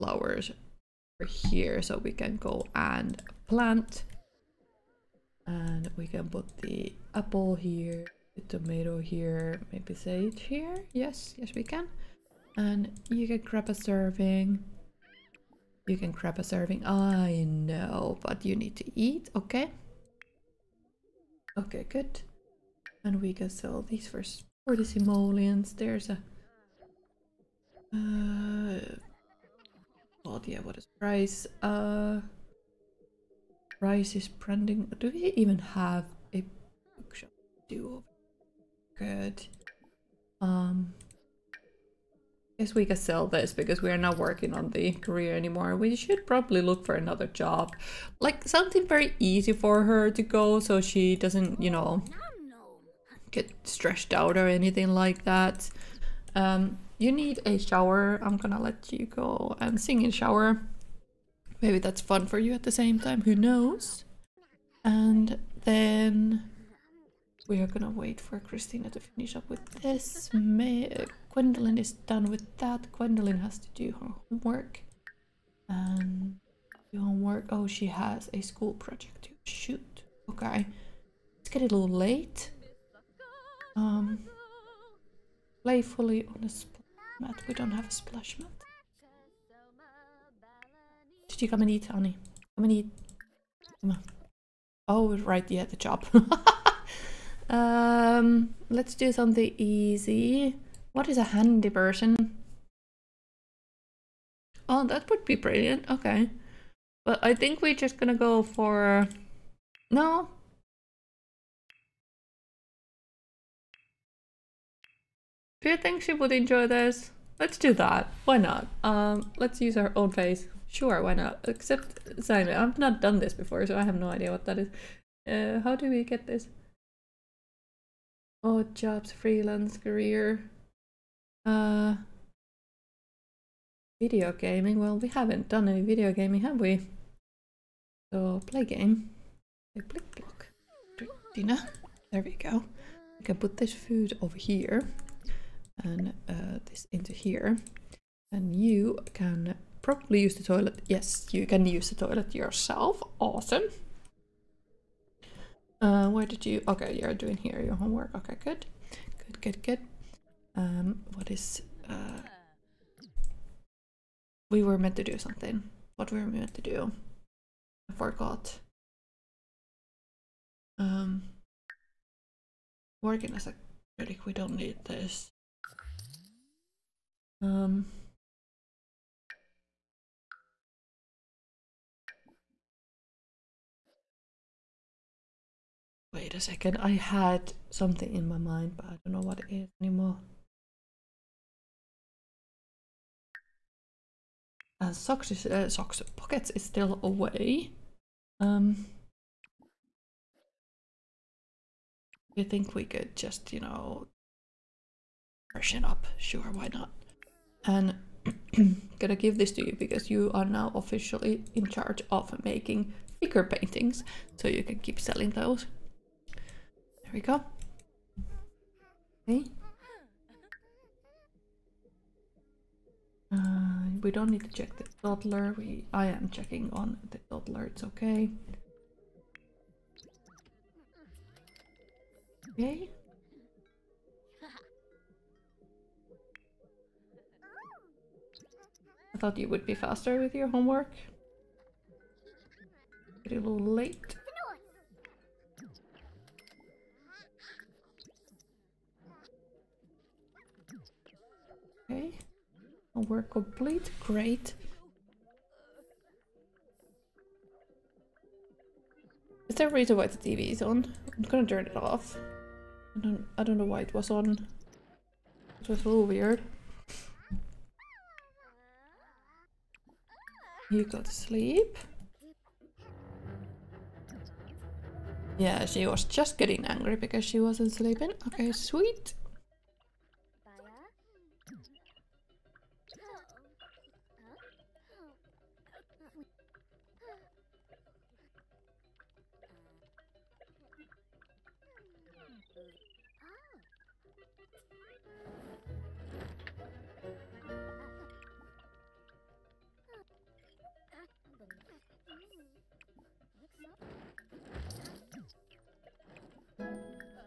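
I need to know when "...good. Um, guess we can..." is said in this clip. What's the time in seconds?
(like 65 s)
38 s.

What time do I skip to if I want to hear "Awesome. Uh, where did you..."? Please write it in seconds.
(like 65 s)
153 s.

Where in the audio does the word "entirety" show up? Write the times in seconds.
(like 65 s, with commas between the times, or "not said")
not said.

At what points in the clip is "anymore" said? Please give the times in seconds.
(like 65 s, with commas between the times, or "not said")
45 s, 189 s.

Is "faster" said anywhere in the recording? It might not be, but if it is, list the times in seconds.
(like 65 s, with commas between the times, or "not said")
239 s.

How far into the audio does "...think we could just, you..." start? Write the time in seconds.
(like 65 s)
202 s.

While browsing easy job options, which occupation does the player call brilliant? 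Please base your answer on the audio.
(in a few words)
handy person.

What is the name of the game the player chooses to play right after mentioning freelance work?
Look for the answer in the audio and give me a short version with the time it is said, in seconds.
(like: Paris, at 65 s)
Blicblock, at 139 s.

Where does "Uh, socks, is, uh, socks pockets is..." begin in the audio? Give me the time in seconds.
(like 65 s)
194 s.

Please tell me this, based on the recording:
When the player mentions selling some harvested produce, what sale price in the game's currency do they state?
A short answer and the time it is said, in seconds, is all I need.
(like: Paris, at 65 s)
40 simoleons, at 24 s.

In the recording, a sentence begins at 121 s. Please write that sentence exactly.
Except Simon, I've not done this before, so I have no idea what that is.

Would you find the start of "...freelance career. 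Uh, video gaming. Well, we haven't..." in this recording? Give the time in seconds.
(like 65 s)
129 s.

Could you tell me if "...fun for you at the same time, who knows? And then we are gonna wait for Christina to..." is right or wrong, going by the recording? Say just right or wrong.
right.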